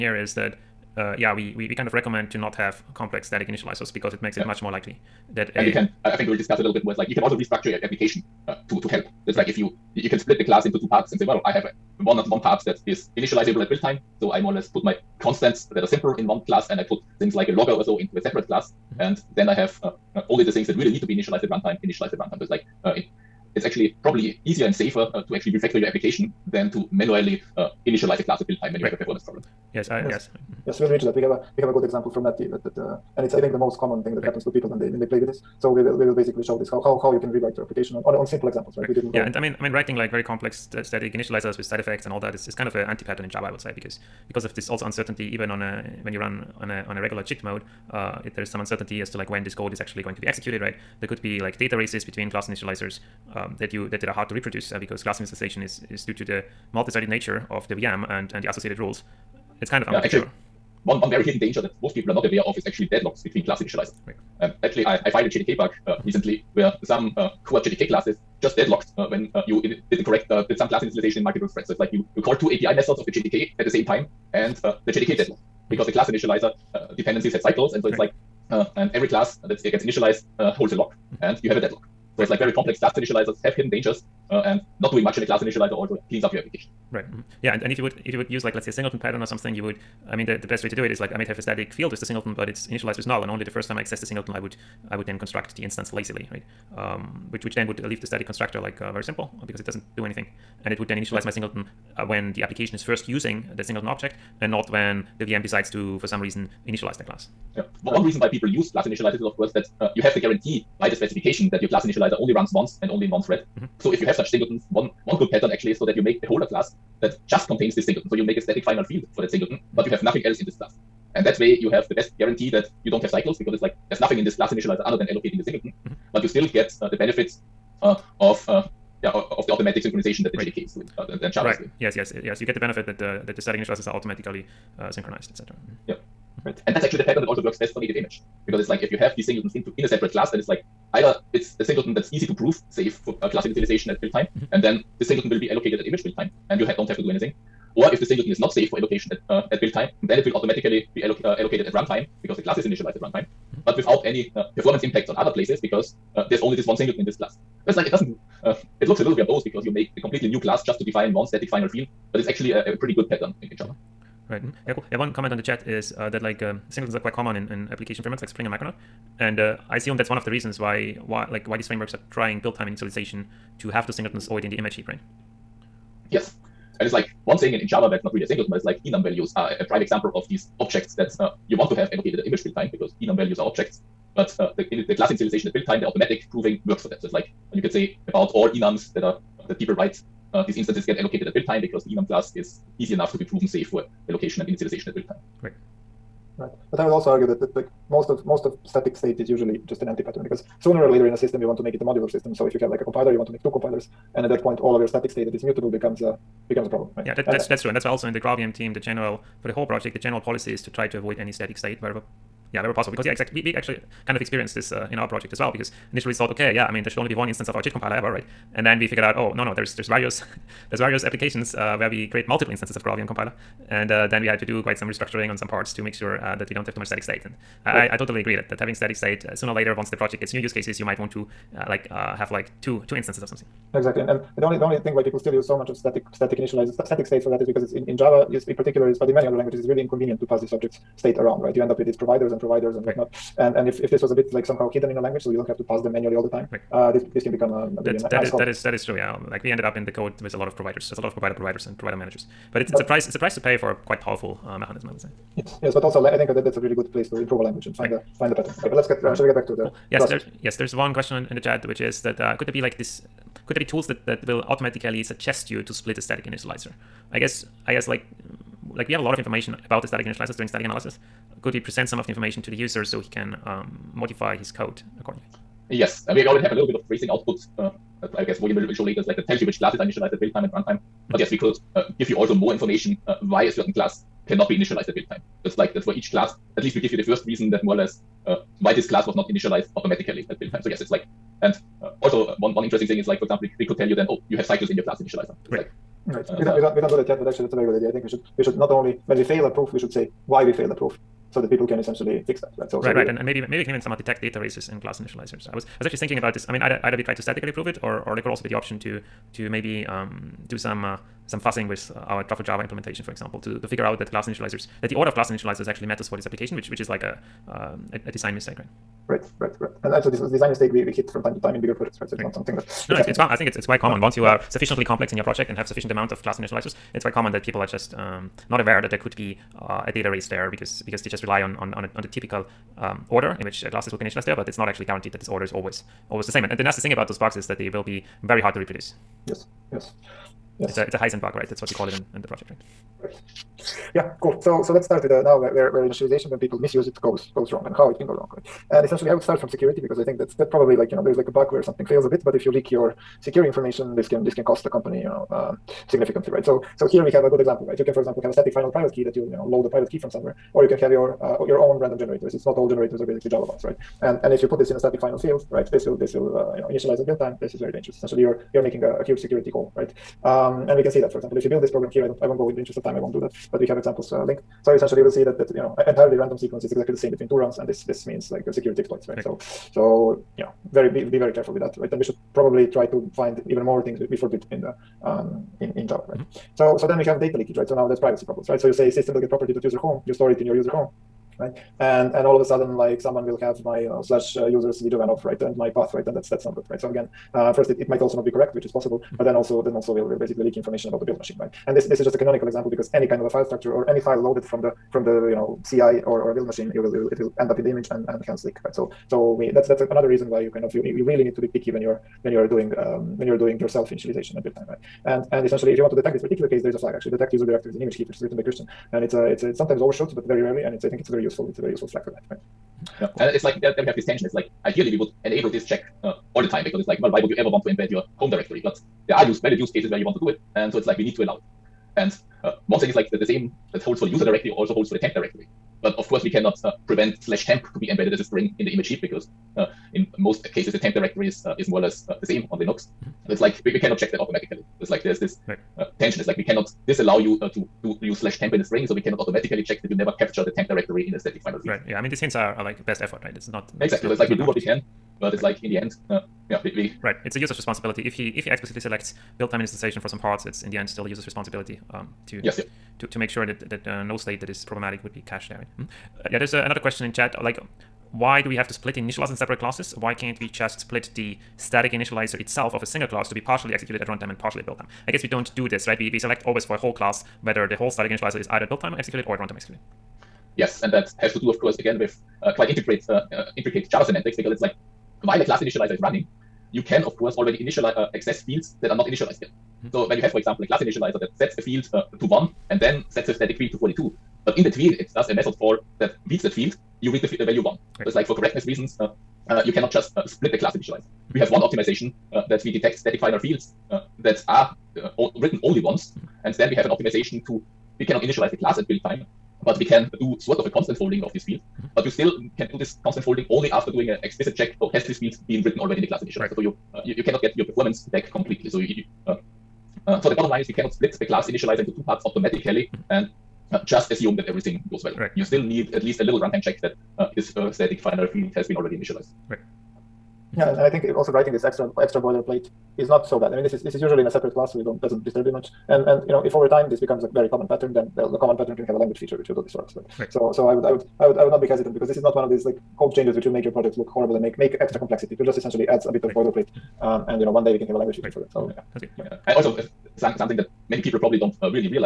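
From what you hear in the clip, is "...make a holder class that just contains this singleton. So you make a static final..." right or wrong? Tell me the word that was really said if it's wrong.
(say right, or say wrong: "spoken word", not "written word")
right.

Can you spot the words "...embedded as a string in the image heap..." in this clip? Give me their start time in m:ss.
7:17.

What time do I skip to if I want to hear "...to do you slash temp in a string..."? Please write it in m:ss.
7:27.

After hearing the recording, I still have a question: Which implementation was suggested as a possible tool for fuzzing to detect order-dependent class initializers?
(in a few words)
Truffle Java implementation.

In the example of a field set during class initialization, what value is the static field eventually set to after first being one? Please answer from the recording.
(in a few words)
42.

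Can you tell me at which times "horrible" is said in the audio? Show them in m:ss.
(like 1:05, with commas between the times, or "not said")
9:04.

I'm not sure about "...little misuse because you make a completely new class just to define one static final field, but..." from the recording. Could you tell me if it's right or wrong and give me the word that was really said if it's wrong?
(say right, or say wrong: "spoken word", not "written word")
wrong: "verbose", not "misuse".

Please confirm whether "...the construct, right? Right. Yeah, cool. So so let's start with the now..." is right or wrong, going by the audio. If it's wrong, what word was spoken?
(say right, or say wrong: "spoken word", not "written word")
wrong: "project", not "construct".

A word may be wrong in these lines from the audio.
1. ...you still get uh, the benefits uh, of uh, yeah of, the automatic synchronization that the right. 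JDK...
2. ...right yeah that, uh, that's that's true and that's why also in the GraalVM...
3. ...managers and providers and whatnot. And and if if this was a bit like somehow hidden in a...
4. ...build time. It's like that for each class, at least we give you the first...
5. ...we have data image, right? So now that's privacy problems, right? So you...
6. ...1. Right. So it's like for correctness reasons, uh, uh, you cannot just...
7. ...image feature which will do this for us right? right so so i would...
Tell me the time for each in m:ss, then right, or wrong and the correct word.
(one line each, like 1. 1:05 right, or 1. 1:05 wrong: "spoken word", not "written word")
1. 2:06 right
2. 3:26 right
3. 4:01 wrong: "providers", not "managers"
4. 4:44 right
5. 6:26 wrong: "leakage", not "image"
6. 8:17 right
7. 8:58 wrong: "language", not "image".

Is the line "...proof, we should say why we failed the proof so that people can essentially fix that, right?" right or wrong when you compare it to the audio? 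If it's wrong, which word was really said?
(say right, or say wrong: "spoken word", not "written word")
right.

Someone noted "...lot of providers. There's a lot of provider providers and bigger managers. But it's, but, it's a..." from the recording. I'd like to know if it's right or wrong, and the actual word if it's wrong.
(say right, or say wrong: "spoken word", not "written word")
wrong: "provider", not "bigger".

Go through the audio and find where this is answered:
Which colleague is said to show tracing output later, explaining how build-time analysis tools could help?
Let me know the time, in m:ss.
4:38.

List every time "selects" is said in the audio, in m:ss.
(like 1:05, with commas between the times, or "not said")
7:38, 7:56.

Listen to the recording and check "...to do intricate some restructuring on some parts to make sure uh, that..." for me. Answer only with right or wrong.
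wrong.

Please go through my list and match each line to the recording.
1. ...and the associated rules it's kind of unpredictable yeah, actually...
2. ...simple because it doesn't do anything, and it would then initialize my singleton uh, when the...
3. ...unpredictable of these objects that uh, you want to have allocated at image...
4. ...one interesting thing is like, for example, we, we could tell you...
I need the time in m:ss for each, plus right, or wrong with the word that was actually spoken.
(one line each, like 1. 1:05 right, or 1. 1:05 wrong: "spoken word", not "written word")
1. 0:58 right
2. 1:39 right
3. 2:59 wrong: "example", not "unpredictable"
4. 4:52 right.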